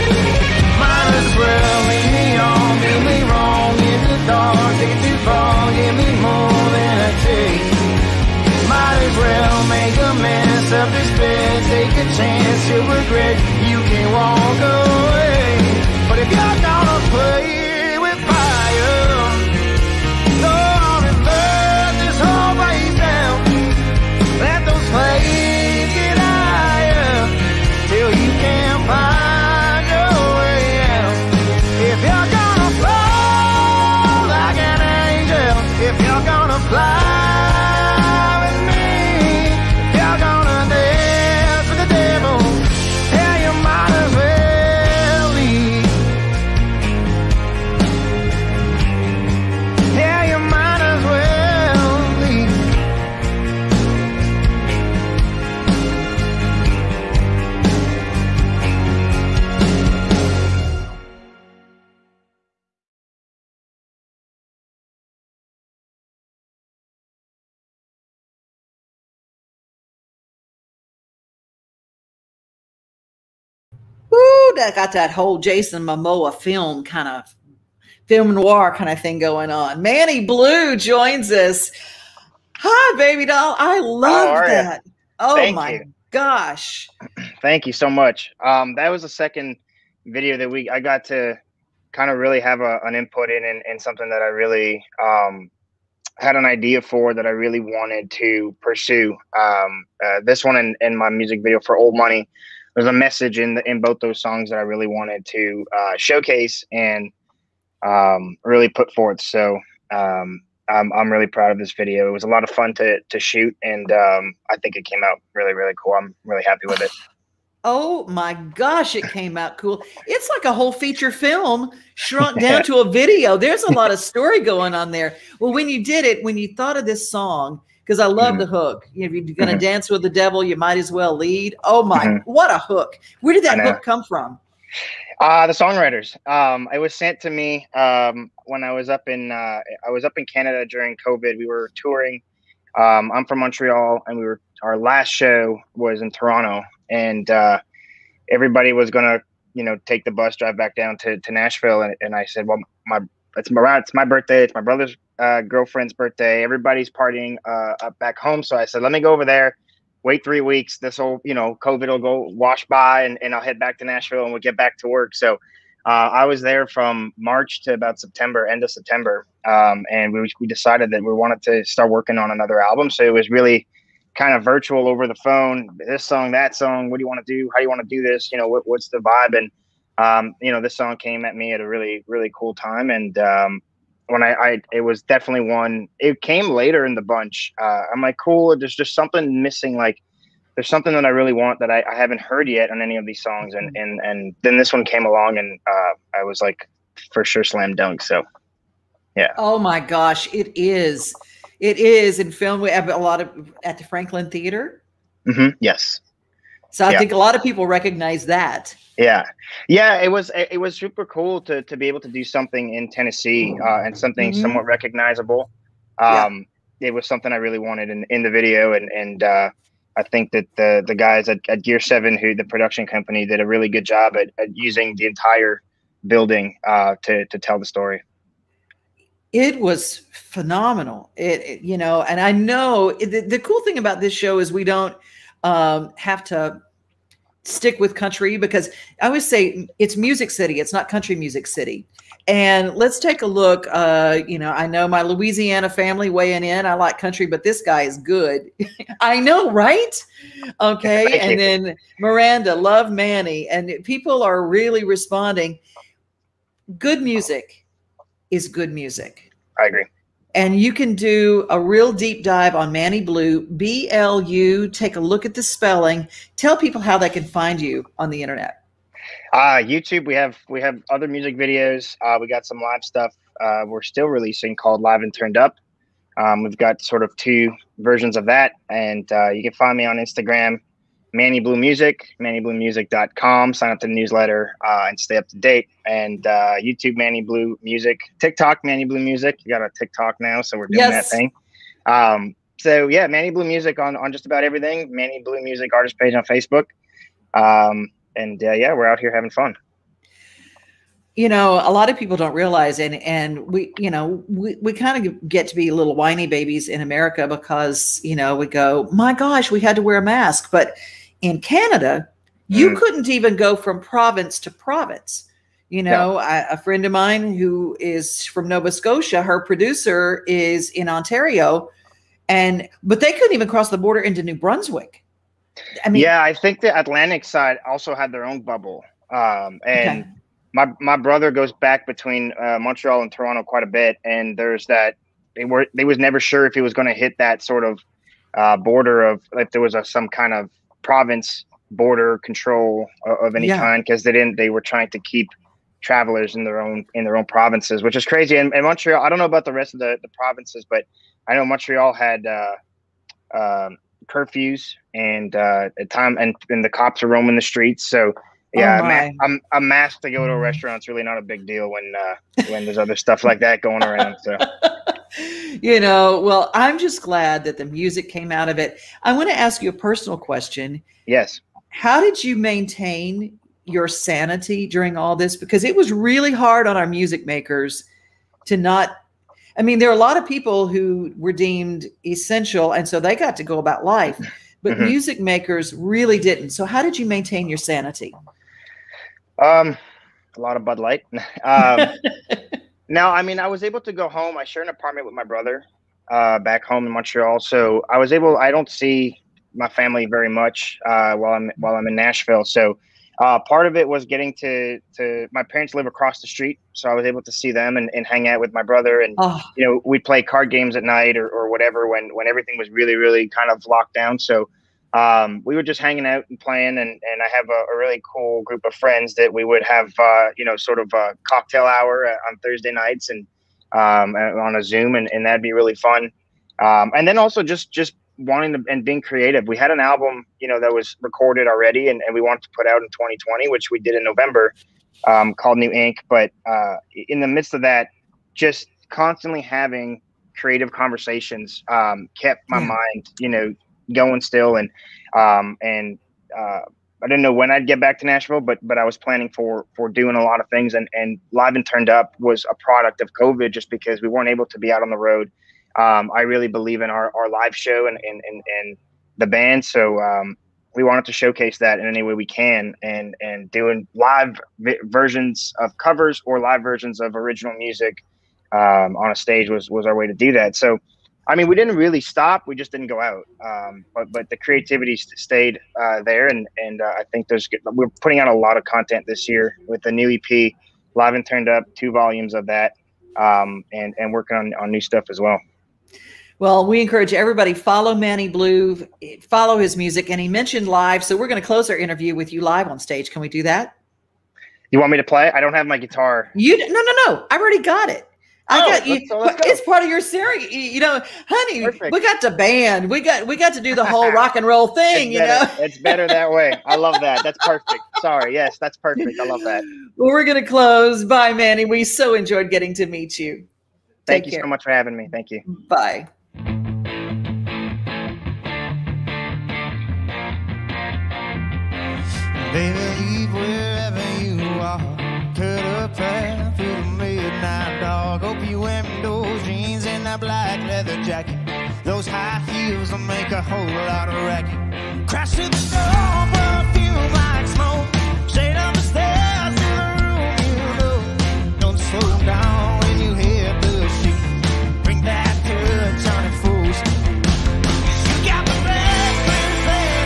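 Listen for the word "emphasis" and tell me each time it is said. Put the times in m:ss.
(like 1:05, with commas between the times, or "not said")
not said.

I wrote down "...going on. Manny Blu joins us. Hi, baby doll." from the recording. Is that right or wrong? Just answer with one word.
right.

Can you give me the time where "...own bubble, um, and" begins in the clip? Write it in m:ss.
5:28.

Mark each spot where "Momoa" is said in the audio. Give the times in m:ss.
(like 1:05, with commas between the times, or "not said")
1:15.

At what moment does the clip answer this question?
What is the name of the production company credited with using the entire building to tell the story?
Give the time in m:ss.
3:41.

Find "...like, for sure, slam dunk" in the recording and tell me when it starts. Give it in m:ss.
3:16.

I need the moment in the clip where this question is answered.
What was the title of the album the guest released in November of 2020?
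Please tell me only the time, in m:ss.
7:15.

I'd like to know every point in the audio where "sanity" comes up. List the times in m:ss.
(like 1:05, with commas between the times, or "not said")
6:13, 6:27.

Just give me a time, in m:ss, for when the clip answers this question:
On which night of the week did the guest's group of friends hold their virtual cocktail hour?
7:02.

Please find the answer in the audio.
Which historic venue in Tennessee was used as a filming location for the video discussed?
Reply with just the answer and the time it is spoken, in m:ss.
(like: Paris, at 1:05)
Franklin Theater, at 3:23.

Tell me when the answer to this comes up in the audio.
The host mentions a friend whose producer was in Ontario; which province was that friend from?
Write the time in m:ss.
5:18.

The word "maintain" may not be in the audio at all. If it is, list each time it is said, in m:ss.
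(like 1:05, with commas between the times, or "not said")
6:12, 6:27.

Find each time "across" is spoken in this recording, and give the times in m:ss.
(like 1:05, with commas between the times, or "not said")
6:45.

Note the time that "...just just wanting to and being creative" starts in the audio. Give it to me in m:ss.
7:07.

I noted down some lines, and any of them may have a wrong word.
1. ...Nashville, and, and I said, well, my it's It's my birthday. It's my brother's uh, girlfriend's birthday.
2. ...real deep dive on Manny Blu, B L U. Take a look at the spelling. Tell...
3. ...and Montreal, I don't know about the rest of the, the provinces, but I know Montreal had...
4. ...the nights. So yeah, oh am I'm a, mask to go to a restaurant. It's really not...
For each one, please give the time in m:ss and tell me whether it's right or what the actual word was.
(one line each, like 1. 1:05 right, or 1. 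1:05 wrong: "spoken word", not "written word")
1. 2:31 right
2. 4:21 right
3. 5:48 right
4. 5:57 wrong: "streets", not "nights".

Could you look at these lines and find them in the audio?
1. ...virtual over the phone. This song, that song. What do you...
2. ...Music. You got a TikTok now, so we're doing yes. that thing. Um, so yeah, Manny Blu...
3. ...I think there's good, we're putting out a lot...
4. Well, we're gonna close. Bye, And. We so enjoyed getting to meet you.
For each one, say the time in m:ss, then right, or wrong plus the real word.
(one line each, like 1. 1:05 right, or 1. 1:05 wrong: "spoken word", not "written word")
1. 2:54 right
2. 4:48 right
3. 7:56 right
4. 8:29 wrong: "Manny", not "And".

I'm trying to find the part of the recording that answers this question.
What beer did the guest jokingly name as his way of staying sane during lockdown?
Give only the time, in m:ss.
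6:30.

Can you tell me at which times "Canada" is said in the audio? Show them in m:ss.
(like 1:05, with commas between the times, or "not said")
2:20, 5:11.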